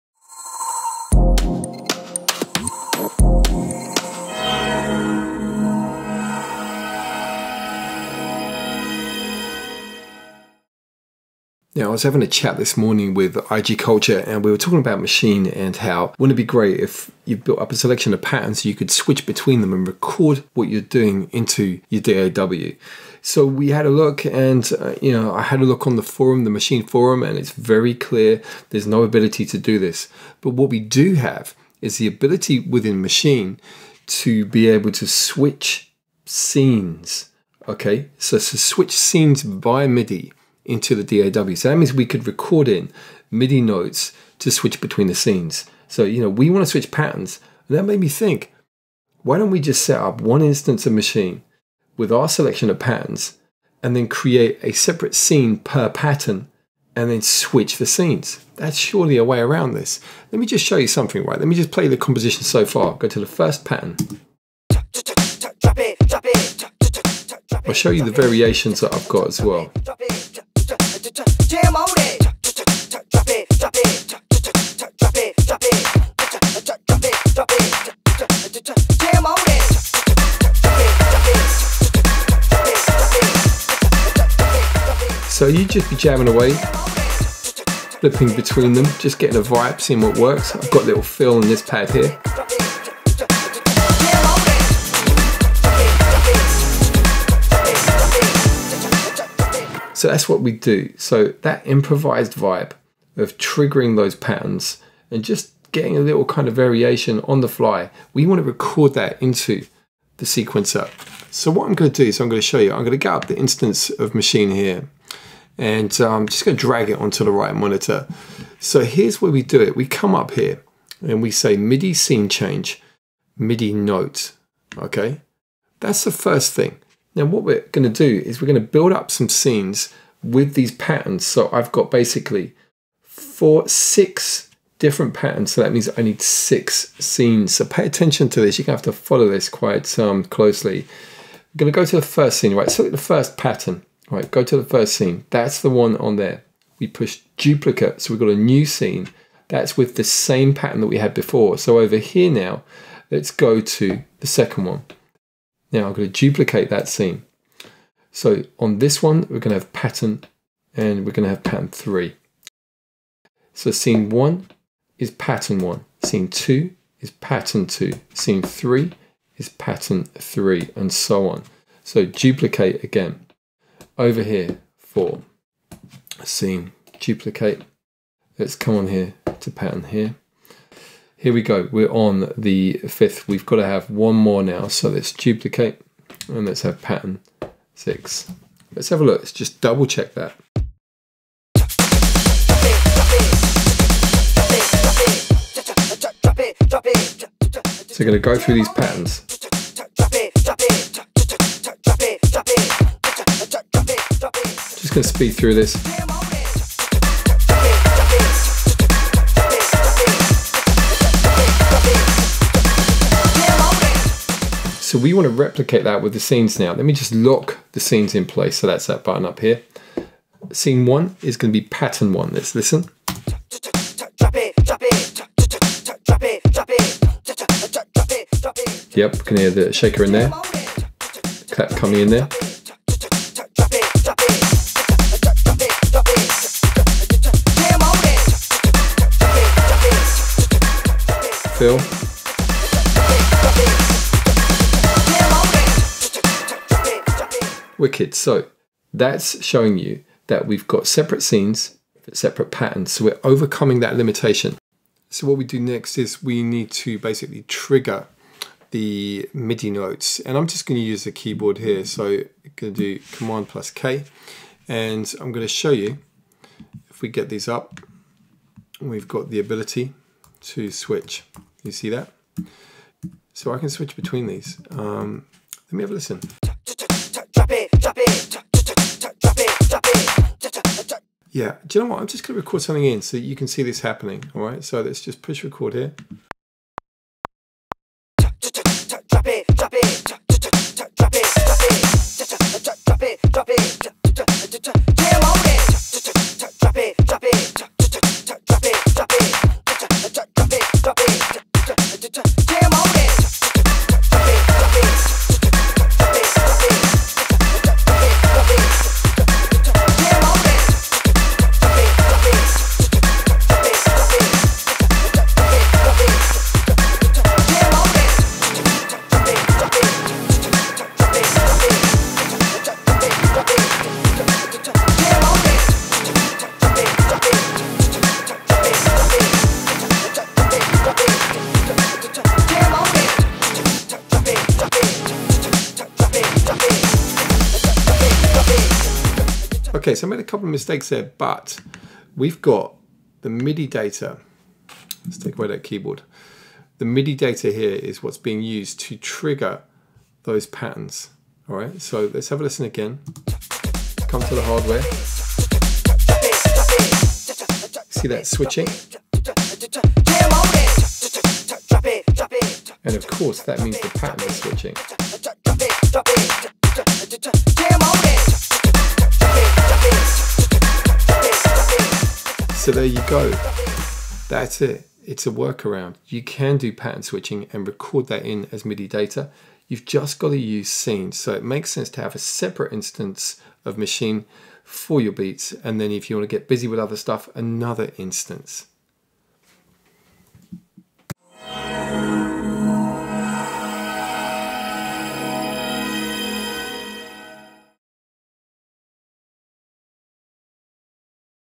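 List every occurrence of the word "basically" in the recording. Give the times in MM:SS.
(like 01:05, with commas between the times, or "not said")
02:11, 04:16.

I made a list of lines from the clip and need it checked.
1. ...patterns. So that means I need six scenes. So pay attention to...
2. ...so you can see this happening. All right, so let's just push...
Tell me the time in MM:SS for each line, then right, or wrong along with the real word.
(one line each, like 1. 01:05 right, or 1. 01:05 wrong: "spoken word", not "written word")
1. 02:15 right
2. 04:43 right.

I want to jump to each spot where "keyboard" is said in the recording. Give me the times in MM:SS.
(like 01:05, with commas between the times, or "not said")
04:21, 05:45.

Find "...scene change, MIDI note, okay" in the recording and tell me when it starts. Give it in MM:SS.
02:01.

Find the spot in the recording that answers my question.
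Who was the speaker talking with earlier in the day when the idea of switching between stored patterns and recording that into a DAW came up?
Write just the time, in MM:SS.
00:13.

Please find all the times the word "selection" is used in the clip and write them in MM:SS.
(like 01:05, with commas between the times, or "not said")
00:17, 00:52.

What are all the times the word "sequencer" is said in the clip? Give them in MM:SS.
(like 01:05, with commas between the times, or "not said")
01:50.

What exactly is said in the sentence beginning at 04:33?
So I can switch between these.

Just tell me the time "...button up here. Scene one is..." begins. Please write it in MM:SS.
03:39.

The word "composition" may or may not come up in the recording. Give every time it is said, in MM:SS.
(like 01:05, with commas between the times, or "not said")
01:01.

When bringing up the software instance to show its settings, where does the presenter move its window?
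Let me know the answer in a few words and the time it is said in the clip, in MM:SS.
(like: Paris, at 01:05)
Right monitor, at 01:57.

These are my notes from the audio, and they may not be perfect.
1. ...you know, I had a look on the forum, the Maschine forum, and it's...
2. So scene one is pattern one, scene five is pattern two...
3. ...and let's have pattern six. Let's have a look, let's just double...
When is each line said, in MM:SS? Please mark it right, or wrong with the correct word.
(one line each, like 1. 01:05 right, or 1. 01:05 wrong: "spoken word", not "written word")
1. 00:25 right
2. 02:43 wrong: "two", not "five"
3. 03:06 right.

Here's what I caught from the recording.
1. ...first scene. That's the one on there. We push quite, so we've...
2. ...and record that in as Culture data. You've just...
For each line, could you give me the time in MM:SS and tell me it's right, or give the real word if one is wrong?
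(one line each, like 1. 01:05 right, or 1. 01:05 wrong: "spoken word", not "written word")
1. 02:24 wrong: "duplicate", not "quite"
2. 06:17 wrong: "MIDI", not "Culture".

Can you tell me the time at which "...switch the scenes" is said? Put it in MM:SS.
00:57.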